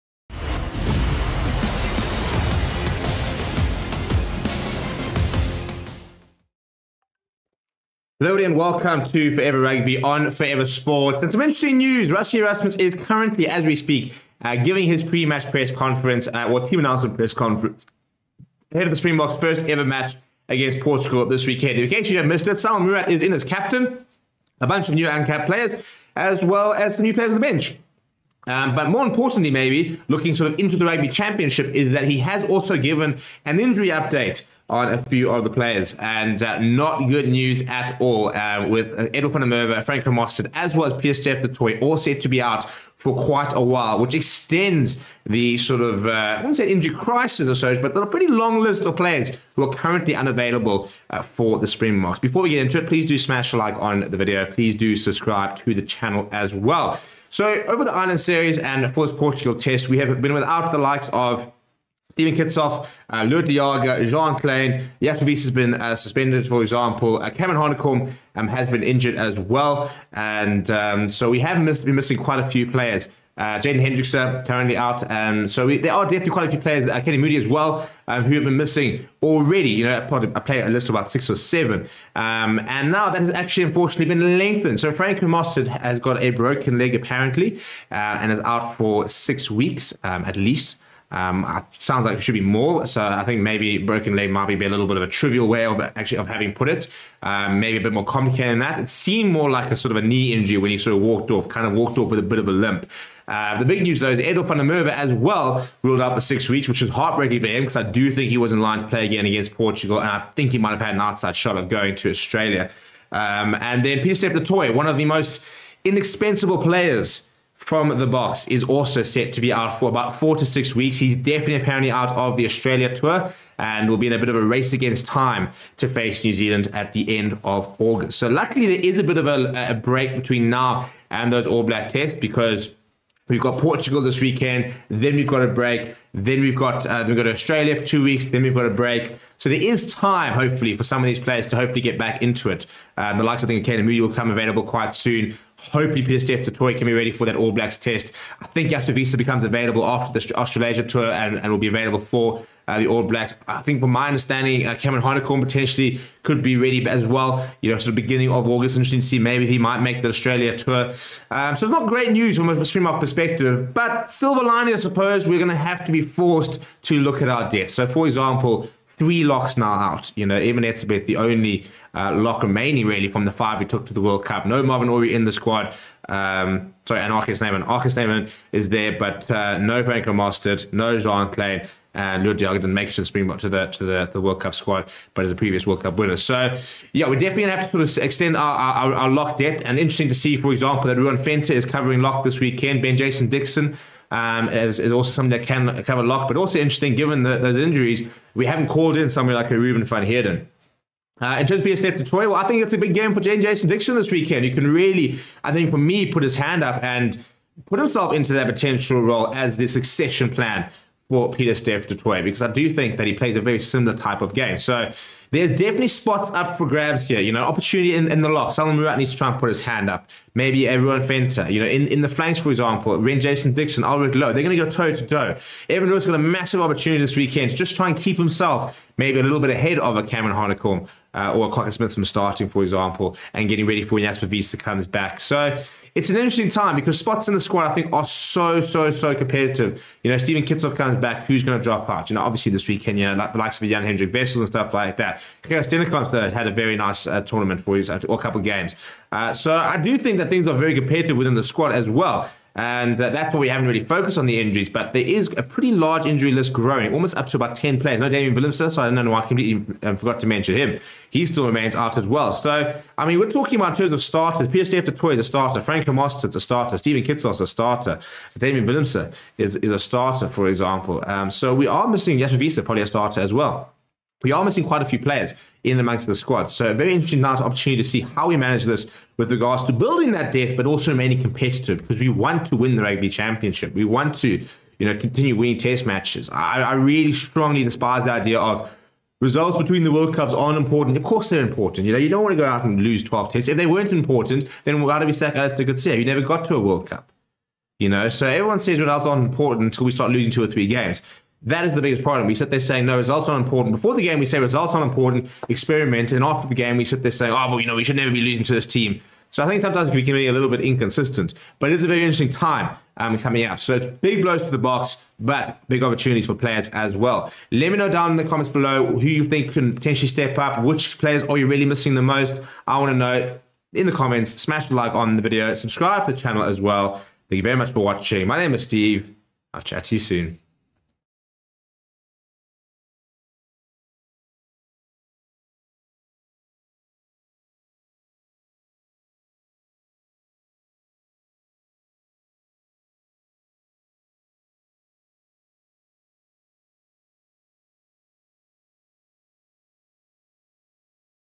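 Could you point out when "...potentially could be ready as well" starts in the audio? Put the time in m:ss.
2:35.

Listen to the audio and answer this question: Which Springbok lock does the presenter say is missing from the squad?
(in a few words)
Marvin Orie.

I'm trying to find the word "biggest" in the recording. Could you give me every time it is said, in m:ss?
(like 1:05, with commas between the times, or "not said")
5:01.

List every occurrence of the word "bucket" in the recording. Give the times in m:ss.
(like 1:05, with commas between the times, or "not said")
not said.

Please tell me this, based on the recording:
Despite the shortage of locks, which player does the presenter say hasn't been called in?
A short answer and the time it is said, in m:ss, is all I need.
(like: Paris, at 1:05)
Ruben van Heerden, at 3:19.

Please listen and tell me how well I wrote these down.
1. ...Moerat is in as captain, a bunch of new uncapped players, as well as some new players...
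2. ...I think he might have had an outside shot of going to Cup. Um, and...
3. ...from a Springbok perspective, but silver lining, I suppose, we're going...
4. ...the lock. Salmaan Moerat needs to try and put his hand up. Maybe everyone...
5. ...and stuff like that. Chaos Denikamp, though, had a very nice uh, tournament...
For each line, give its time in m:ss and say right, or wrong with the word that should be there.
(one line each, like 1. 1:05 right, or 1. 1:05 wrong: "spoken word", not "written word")
1. 0:22 right
2. 1:50 wrong: "Australia", not "Cup"
3. 2:42 right
4. 3:38 right
5. 4:04 right.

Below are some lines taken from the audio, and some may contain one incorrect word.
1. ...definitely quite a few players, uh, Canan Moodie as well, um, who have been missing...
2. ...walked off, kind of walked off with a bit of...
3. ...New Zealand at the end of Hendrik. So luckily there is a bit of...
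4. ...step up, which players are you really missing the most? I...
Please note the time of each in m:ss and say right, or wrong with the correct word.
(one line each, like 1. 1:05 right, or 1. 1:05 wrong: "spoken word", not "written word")
1. 1:16 right
2. 1:41 right
3. 2:06 wrong: "August", not "Hendrik"
4. 5:20 right.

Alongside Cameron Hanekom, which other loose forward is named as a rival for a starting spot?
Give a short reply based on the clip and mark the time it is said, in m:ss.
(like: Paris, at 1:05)
Kwagga Smith, at 3:51.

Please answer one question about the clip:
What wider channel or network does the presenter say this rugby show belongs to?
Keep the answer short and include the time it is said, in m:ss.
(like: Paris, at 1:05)
Forever Sports, at 0:10.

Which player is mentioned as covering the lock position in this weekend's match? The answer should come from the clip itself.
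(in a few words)
Ruan Venter.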